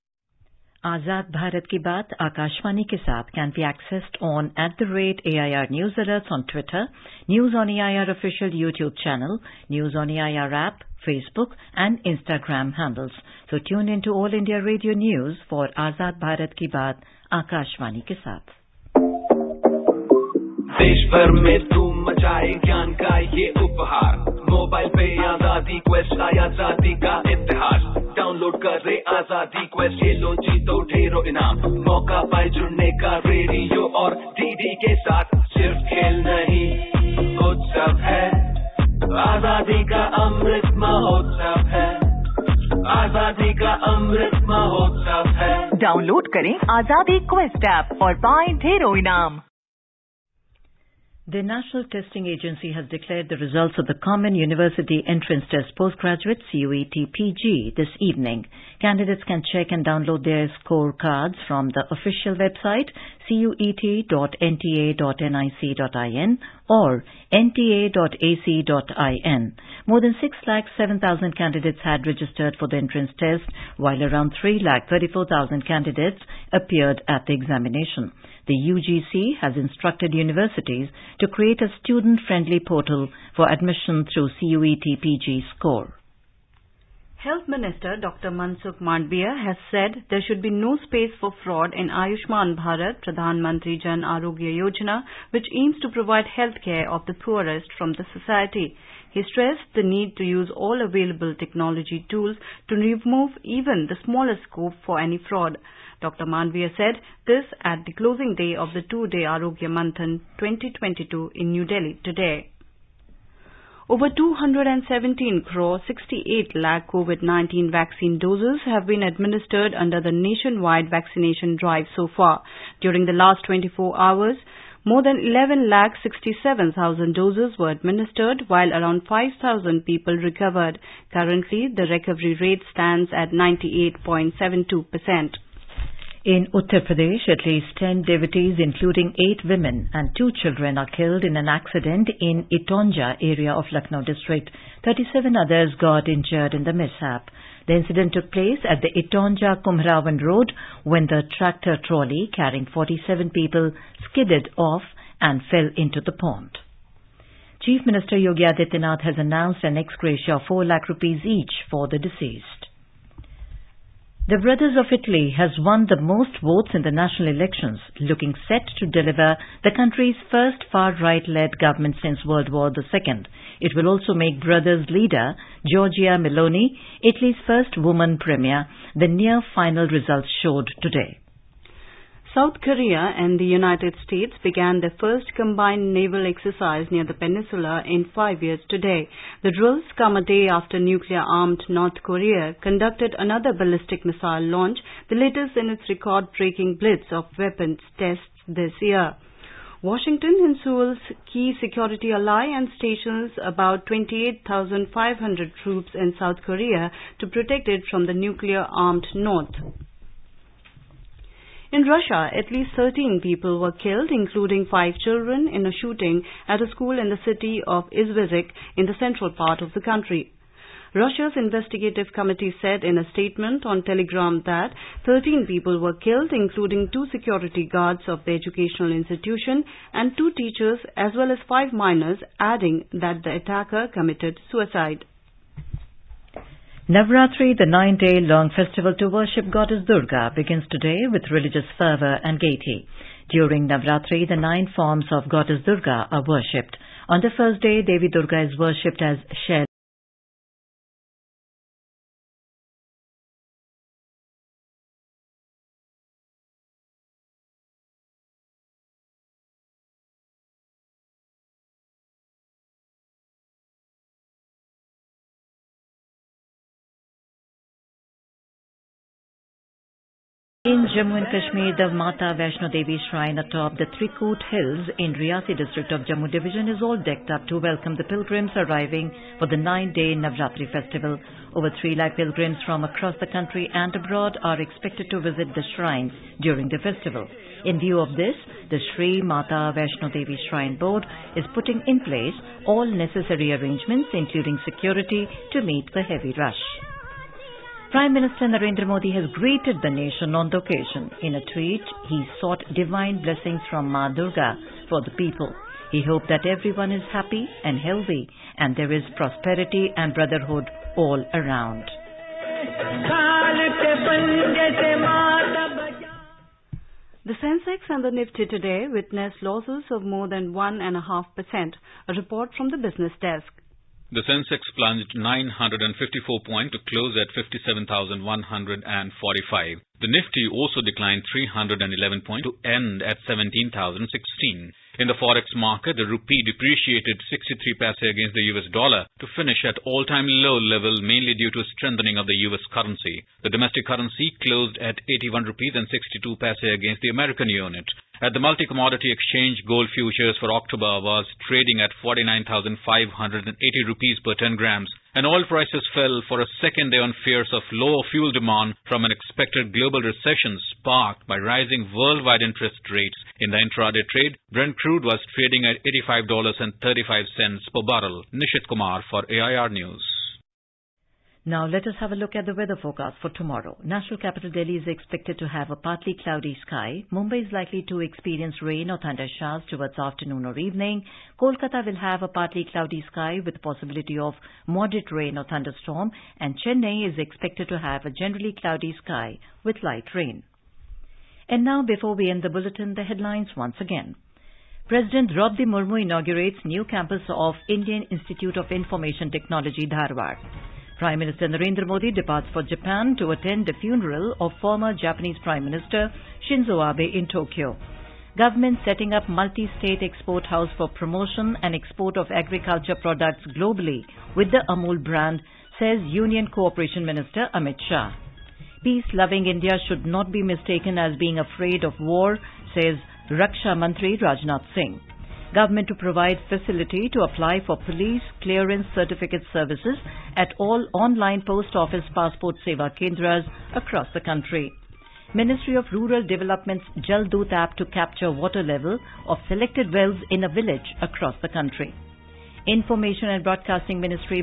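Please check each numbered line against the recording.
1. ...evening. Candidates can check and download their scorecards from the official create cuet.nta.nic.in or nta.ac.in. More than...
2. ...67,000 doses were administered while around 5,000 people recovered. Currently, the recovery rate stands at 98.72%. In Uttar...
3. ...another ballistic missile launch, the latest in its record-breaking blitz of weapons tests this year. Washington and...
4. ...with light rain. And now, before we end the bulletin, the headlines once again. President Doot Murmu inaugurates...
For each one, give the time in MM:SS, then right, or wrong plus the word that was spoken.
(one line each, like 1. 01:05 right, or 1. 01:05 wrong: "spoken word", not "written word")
1. 00:57 wrong: "website", not "create"
2. 02:06 right
3. 03:13 right
4. 06:29 wrong: "Draupadi", not "Doot".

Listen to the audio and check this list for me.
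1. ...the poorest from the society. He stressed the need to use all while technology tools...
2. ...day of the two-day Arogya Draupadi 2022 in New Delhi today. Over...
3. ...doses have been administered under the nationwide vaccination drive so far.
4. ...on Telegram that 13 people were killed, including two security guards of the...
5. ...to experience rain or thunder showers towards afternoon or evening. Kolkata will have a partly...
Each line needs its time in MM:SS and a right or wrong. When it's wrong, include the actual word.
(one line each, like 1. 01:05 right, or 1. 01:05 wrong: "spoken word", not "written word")
1. 01:37 wrong: "available", not "while"
2. 01:48 wrong: "Manthan", not "Draupadi"
3. 01:58 right
4. 03:43 right
5. 06:17 right.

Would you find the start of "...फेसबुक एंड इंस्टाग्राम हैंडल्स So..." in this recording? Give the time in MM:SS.
00:11.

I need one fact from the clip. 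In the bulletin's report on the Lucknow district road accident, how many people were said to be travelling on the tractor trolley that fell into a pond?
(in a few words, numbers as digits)
47.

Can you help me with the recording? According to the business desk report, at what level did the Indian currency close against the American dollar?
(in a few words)
81 rupees 62 paise.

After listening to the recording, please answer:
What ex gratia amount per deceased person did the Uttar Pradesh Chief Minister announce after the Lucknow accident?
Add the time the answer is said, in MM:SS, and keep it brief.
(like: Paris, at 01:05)
4 lakh rupees, at 02:40.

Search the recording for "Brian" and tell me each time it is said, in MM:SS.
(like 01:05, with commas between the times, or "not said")
not said.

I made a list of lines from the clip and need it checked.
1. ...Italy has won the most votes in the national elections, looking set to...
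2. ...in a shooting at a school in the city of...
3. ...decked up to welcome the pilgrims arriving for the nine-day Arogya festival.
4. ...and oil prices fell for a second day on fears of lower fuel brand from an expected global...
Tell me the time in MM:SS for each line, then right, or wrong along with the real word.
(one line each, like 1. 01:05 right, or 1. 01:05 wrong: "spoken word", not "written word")
1. 02:44 right
2. 03:35 right
3. 04:36 wrong: "Navratri", not "Arogya"
4. 05:55 wrong: "demand", not "brand".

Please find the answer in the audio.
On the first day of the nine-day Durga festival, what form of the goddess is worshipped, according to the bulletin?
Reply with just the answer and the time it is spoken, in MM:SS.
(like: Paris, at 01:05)
Shaila, at 04:09.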